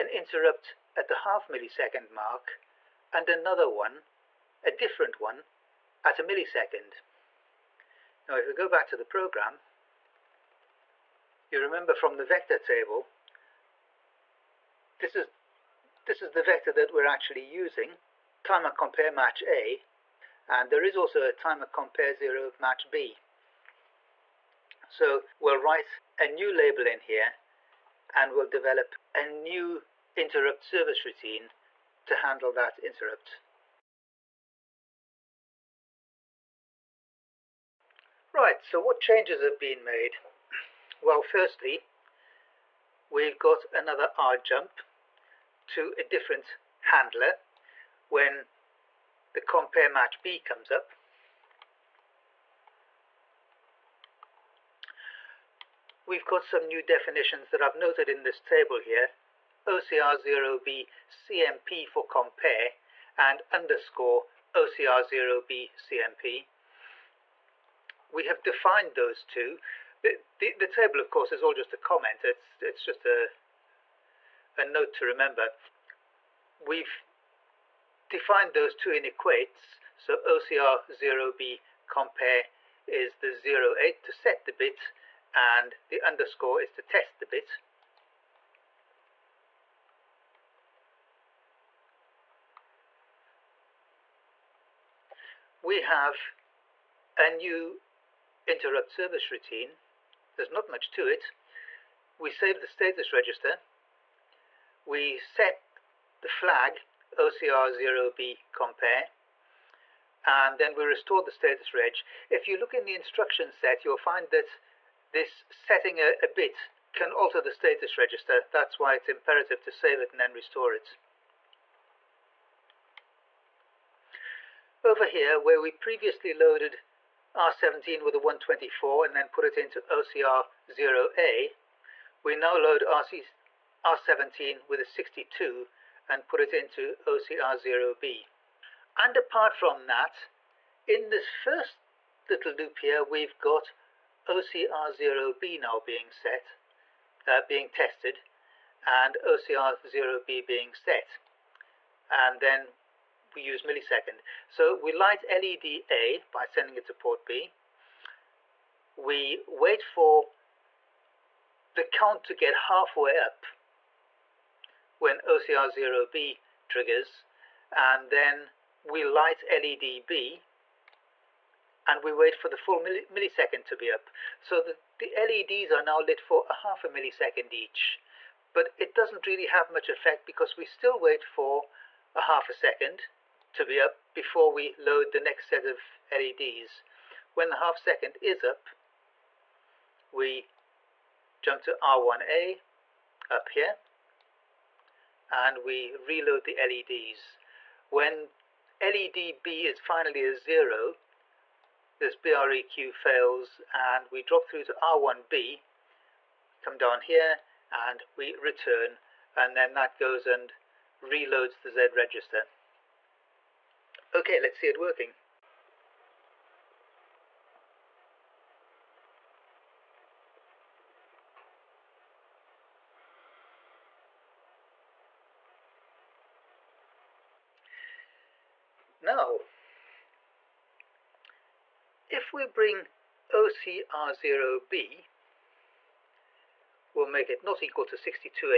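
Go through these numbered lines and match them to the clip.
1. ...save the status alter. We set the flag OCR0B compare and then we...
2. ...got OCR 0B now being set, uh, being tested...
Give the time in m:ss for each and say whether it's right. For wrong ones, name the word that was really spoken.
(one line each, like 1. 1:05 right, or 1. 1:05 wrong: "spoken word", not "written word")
1. 1:42 wrong: "register", not "alter"
2. 2:23 right.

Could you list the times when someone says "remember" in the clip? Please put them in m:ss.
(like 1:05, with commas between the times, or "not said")
0:11, 1:15.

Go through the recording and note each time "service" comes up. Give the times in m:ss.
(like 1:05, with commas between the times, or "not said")
0:30, 1:38.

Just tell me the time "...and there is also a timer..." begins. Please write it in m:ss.
0:20.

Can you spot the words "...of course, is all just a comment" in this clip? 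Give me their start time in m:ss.
1:10.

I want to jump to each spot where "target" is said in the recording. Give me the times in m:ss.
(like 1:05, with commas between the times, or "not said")
not said.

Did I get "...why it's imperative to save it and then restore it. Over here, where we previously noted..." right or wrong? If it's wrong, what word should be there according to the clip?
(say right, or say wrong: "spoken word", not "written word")
wrong: "loaded", not "noted".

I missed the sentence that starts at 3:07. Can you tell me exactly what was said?
When the half second is up, we jump to R1A up here and we reload the LEDs.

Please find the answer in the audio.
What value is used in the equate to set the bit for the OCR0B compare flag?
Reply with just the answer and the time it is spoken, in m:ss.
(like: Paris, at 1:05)
08, at 1:23.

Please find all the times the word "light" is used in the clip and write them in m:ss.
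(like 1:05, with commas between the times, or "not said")
2:34, 2:49.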